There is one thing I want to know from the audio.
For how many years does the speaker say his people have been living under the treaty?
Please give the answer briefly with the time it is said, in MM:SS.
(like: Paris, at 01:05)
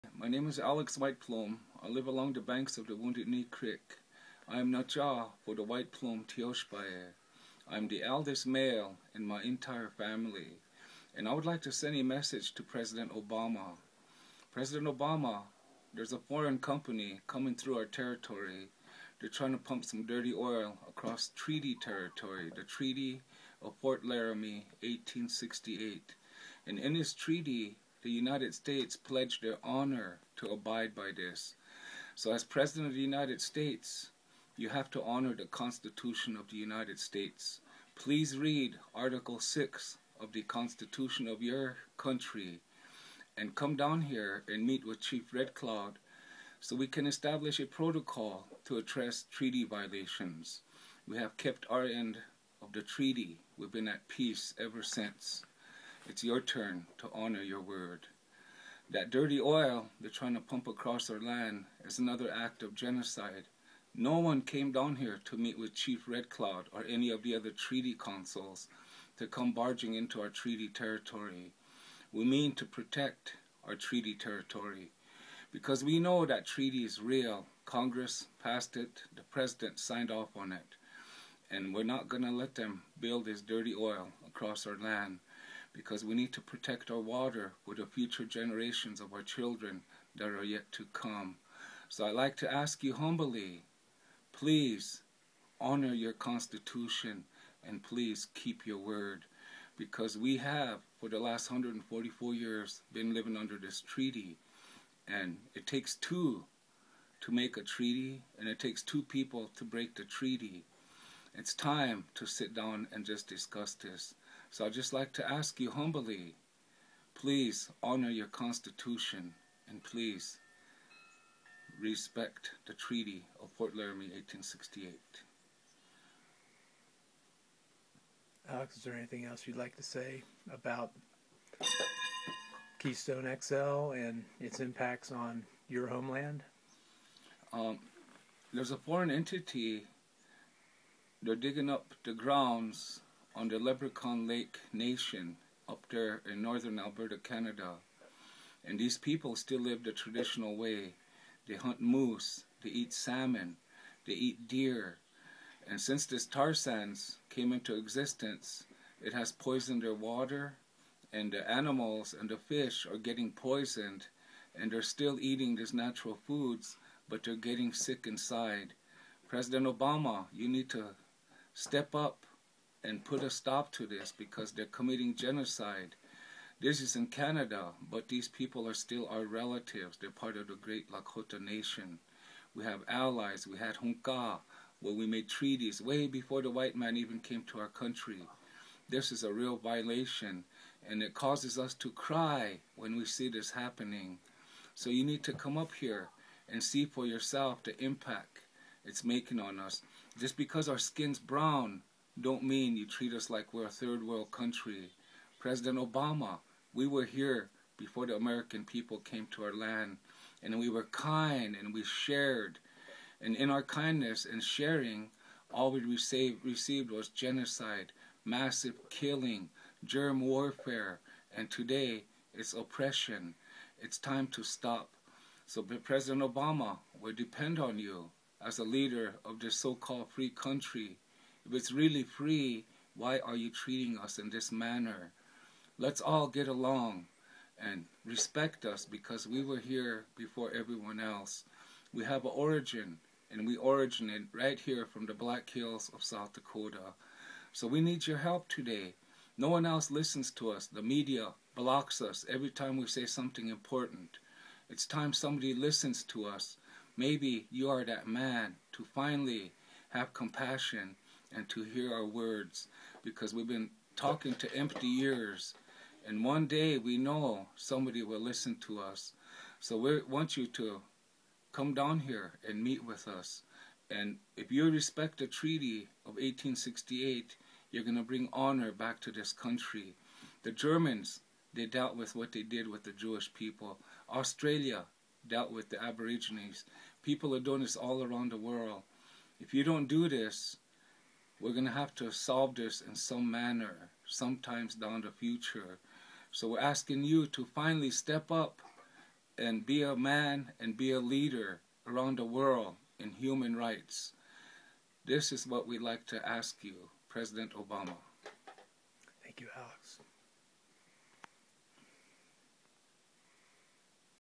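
144, at 01:41.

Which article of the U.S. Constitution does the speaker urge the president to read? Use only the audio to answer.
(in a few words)
Article 6.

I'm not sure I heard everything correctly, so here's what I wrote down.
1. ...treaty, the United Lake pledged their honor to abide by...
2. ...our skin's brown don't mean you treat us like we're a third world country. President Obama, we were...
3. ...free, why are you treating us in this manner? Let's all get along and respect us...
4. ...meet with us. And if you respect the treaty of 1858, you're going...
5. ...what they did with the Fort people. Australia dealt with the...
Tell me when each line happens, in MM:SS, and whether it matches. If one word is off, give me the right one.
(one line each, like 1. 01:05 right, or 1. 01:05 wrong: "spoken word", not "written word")
1. 00:27 wrong: "States", not "Lake"
2. 03:20 right
3. 03:52 right
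4. 04:32 wrong: "1868", not "1858"
5. 04:42 wrong: "Jewish", not "Fort".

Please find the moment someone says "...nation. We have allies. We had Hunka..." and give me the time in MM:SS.
03:01.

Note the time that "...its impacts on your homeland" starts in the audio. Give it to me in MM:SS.
02:14.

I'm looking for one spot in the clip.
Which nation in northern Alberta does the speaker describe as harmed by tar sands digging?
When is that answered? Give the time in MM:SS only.
02:23.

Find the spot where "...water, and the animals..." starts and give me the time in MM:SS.
02:39.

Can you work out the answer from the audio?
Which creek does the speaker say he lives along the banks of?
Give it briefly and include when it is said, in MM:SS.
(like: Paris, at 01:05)
Wounded Knee Creek, at 00:02.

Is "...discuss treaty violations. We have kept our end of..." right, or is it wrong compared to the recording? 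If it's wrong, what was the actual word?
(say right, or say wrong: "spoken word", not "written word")
wrong: "address", not "discuss".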